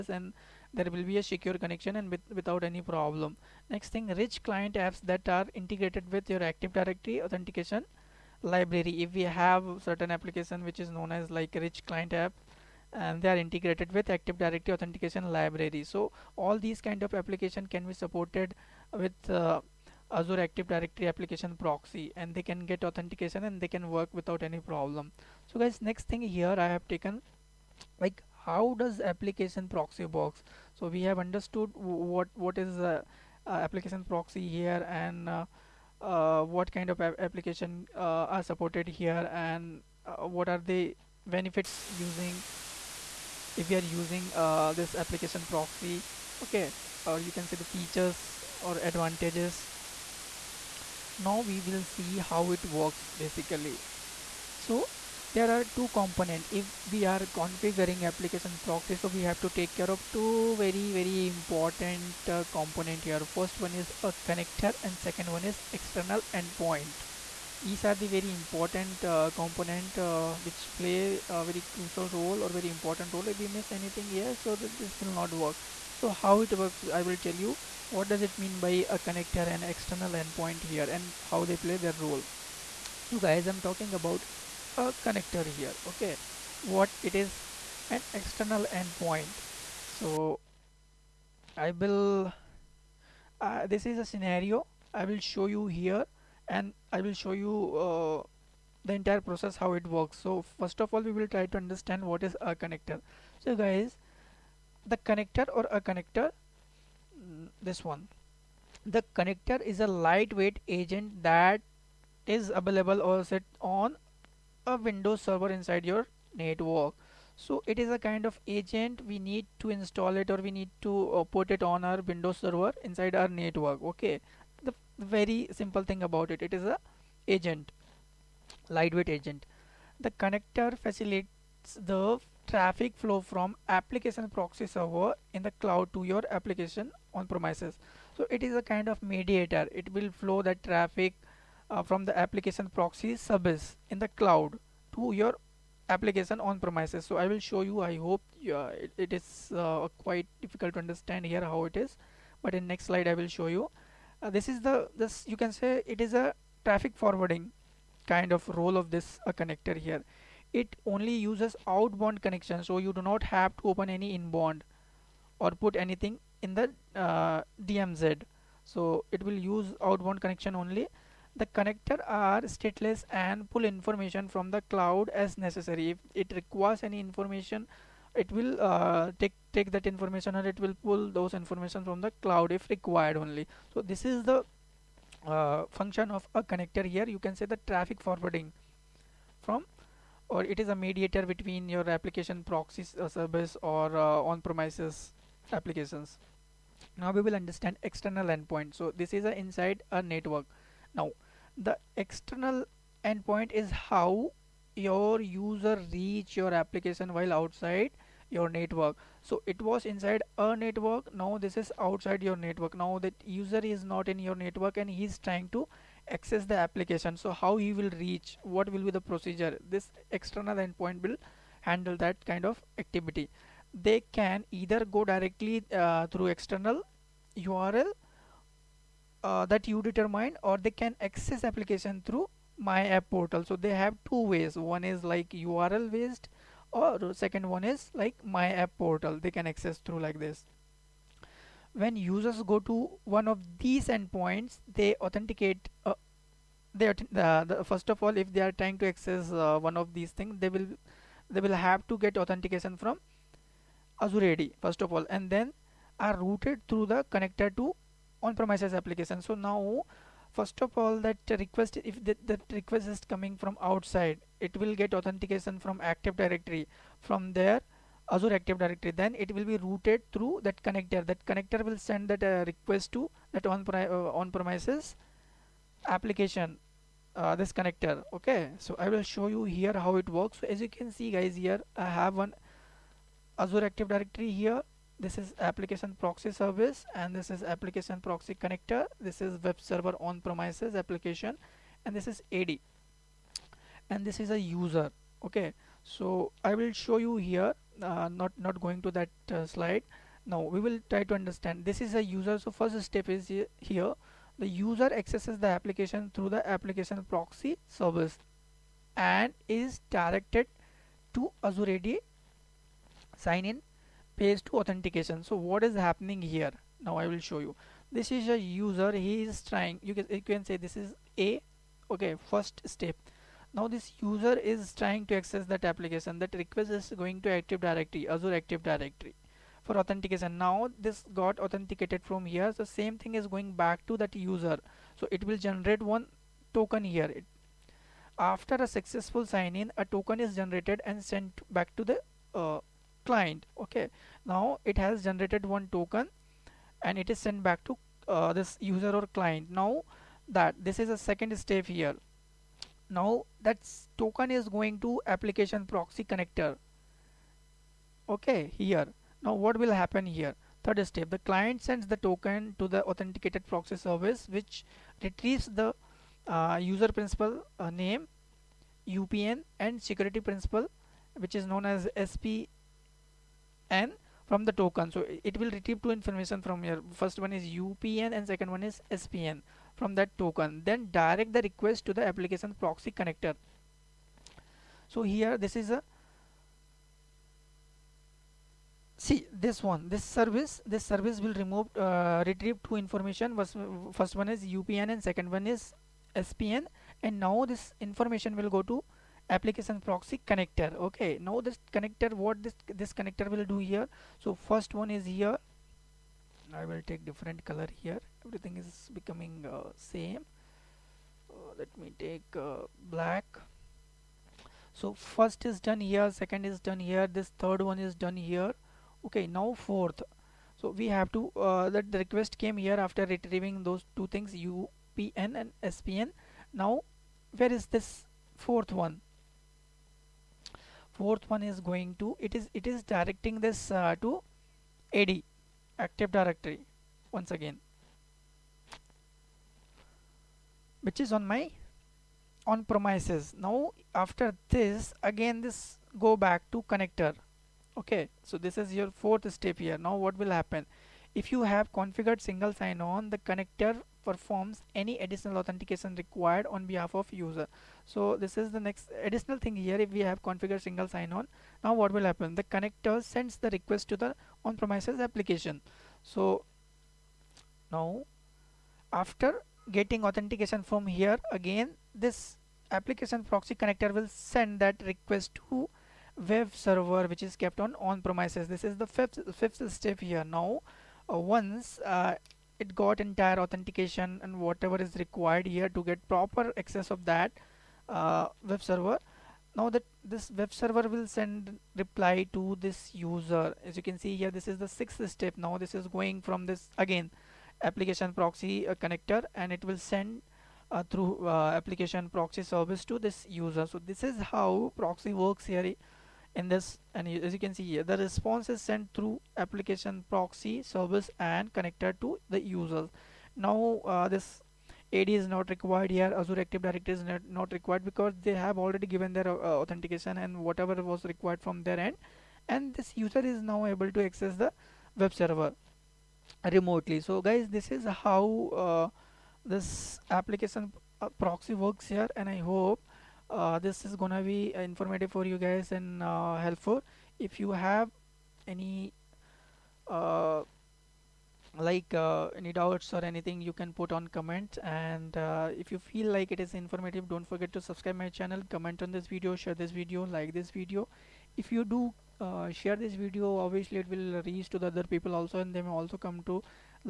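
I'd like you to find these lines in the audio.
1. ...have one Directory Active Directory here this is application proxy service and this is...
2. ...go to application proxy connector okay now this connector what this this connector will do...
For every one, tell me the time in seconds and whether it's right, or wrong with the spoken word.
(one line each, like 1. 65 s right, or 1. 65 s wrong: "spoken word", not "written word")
1. 281 s wrong: "Azure", not "Directory"
2. 398 s right.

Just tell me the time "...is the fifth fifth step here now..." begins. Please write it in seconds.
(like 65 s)
478 s.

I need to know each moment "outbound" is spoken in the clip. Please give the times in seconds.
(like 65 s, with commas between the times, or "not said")
161 s, 169 s.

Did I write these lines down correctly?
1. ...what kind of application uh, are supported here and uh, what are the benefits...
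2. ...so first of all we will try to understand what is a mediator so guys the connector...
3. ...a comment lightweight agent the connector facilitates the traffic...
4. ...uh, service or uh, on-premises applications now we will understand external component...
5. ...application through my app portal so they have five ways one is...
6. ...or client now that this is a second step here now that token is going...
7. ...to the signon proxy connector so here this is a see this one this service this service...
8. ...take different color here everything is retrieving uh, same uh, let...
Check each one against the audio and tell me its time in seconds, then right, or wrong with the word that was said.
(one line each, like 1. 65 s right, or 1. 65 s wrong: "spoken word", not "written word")
1. 36 s right
2. 100 s wrong: "connector", not "mediator"
3. 126 s wrong: "agent", not "comment"
4. 193 s wrong: "endpoint", not "component"
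5. 231 s wrong: "two", not "five"
6. 348 s right
7. 381 s wrong: "application", not "signon"
8. 406 s wrong: "becoming", not "retrieving".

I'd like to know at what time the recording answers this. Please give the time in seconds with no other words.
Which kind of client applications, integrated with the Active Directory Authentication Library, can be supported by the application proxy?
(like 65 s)
4 s.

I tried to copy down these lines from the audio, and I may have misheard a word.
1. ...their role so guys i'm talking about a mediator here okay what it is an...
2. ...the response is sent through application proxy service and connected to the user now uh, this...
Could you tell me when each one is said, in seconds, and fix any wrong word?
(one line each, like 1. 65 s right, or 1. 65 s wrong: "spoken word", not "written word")
1. 81 s wrong: "connector", not "mediator"
2. 507 s right.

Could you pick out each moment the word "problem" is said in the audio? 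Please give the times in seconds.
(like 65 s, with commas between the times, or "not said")
2 s, 24 s.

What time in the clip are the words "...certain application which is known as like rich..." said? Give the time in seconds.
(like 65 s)
9 s.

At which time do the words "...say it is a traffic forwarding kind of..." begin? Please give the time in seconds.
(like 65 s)
155 s.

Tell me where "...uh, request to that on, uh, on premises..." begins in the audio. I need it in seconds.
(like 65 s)
272 s.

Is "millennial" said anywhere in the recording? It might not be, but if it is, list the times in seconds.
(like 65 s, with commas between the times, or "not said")
not said.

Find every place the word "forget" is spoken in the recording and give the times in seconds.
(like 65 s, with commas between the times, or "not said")
547 s.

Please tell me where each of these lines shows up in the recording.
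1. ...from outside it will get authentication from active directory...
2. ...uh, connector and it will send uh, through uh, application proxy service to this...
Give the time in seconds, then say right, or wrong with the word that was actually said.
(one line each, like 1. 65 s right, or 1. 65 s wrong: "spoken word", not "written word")
1. 263 s right
2. 498 s right.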